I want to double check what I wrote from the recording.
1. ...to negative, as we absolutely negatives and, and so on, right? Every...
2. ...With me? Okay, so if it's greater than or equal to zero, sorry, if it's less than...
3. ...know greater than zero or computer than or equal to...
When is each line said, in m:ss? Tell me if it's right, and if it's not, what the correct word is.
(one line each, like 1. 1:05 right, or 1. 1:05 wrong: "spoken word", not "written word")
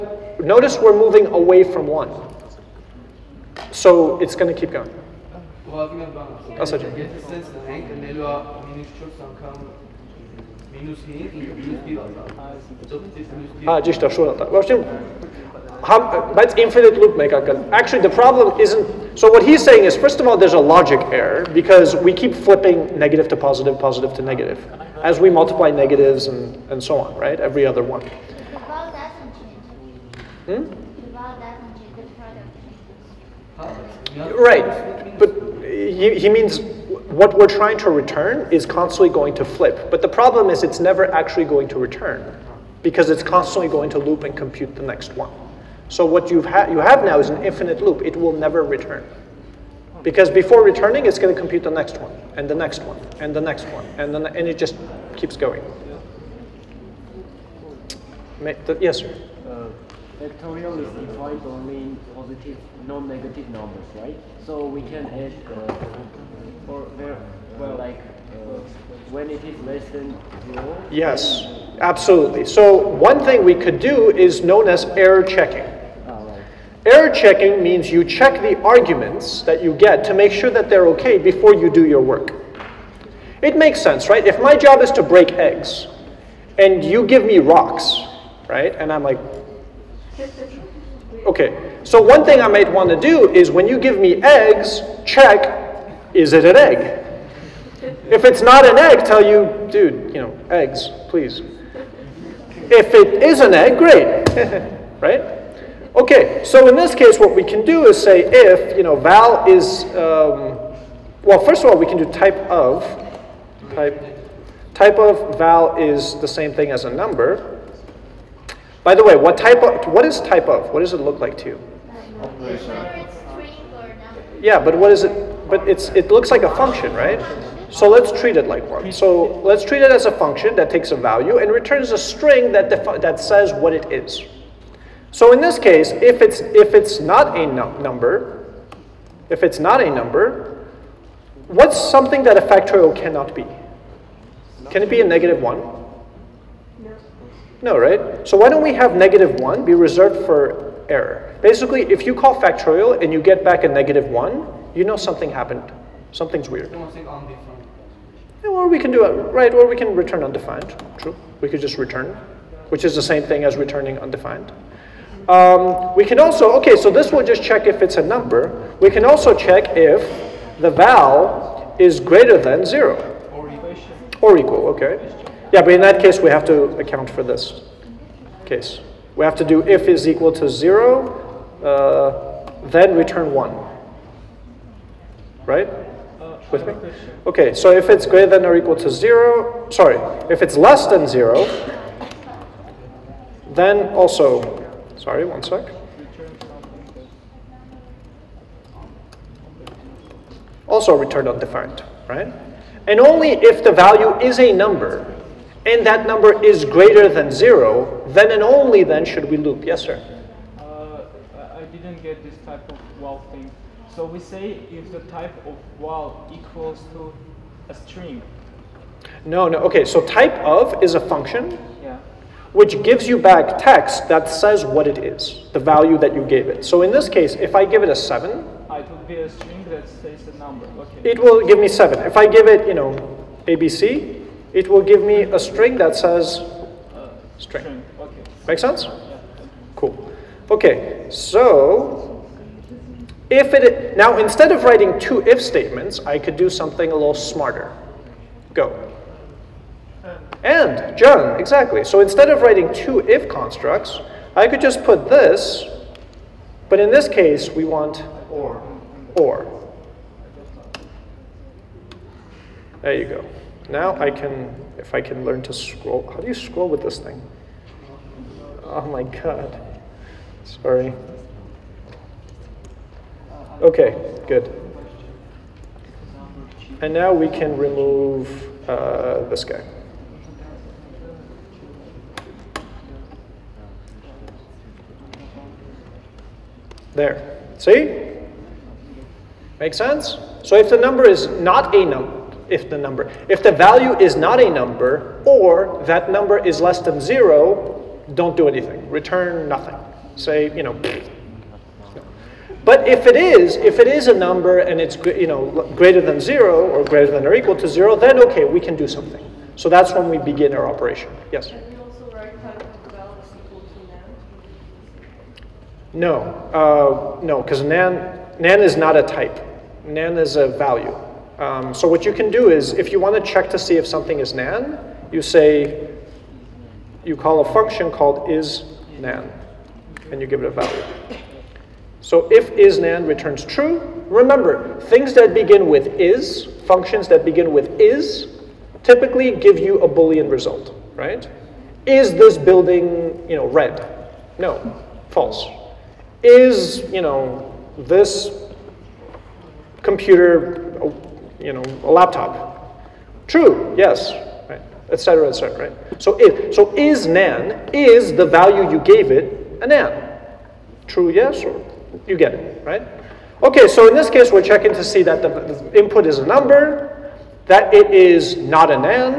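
1. 0:24 wrong: "multiply", not "absolutely"
2. 3:06 right
3. 5:05 wrong: "greater", not "computer".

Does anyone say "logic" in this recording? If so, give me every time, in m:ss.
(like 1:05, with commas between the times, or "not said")
0:20.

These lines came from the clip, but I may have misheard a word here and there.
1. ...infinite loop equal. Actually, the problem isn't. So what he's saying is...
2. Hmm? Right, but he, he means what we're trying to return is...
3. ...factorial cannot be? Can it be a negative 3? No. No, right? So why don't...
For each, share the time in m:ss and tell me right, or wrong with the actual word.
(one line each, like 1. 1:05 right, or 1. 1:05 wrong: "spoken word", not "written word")
1. 0:16 wrong: "mekakal", not "equal"
2. 0:30 right
3. 2:22 wrong: "1", not "3".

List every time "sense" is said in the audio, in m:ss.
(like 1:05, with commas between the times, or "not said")
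1:23, 3:58, 4:49.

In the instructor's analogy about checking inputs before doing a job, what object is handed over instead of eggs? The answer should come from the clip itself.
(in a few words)
rocks.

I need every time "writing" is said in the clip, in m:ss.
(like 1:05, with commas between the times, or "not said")
4:04, 4:12.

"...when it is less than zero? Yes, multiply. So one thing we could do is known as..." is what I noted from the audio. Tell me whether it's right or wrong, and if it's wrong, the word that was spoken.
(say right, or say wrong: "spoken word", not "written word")
wrong: "absolutely", not "multiply".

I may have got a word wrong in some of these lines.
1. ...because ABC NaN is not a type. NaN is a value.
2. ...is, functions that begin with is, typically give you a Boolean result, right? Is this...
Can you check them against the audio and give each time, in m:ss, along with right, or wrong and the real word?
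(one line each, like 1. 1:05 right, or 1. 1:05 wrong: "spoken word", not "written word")
1. 5:17 wrong: "NaN", not "ABC"
2. 5:36 right.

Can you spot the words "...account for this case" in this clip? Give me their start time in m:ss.
2:56.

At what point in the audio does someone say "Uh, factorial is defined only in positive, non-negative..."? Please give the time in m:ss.
0:59.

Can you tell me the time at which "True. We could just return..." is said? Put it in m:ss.
2:40.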